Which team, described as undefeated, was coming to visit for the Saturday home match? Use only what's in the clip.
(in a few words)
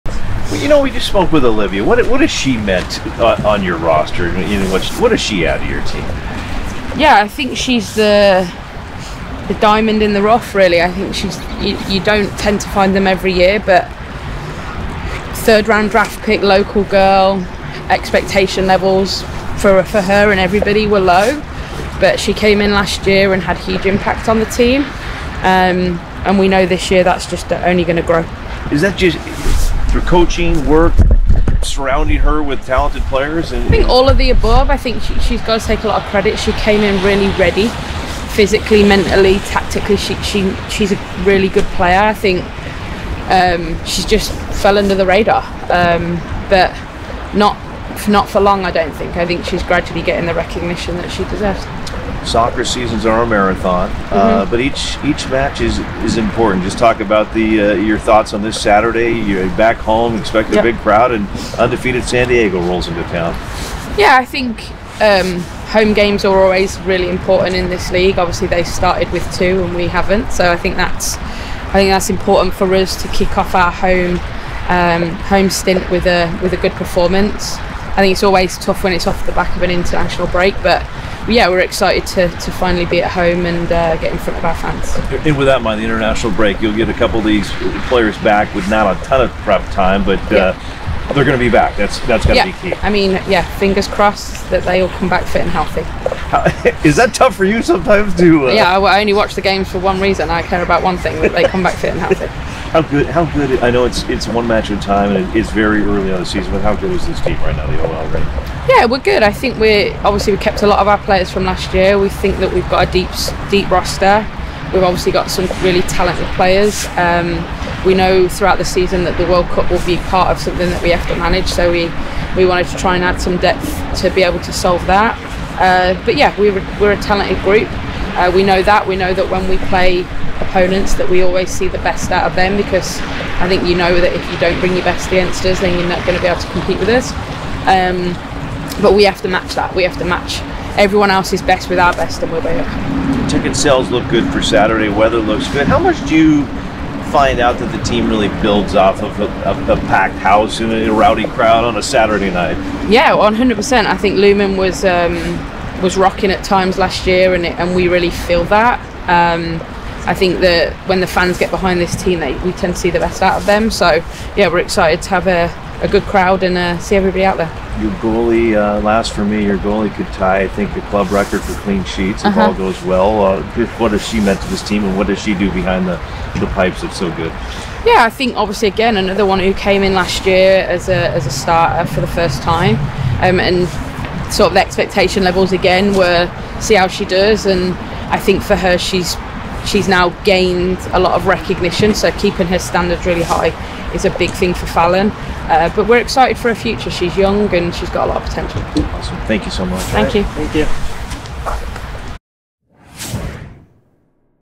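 San Diego.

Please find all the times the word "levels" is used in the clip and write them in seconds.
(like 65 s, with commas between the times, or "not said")
18 s, 185 s.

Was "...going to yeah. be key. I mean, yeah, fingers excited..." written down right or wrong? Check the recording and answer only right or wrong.
wrong.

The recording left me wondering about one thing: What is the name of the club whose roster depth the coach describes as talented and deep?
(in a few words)
OL Reign.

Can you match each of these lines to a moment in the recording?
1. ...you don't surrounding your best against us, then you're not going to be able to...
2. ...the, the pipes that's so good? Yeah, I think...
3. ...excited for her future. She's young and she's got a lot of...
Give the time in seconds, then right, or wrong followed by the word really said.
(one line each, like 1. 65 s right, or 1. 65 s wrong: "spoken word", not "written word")
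1. 134 s wrong: "bring", not "surrounding"
2. 175 s right
3. 195 s right.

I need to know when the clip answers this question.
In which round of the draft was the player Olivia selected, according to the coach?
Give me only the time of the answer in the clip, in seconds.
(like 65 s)
15 s.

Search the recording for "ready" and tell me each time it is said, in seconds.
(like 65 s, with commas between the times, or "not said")
37 s.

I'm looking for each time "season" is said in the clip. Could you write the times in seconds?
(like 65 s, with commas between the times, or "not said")
52 s, 106 s, 118 s.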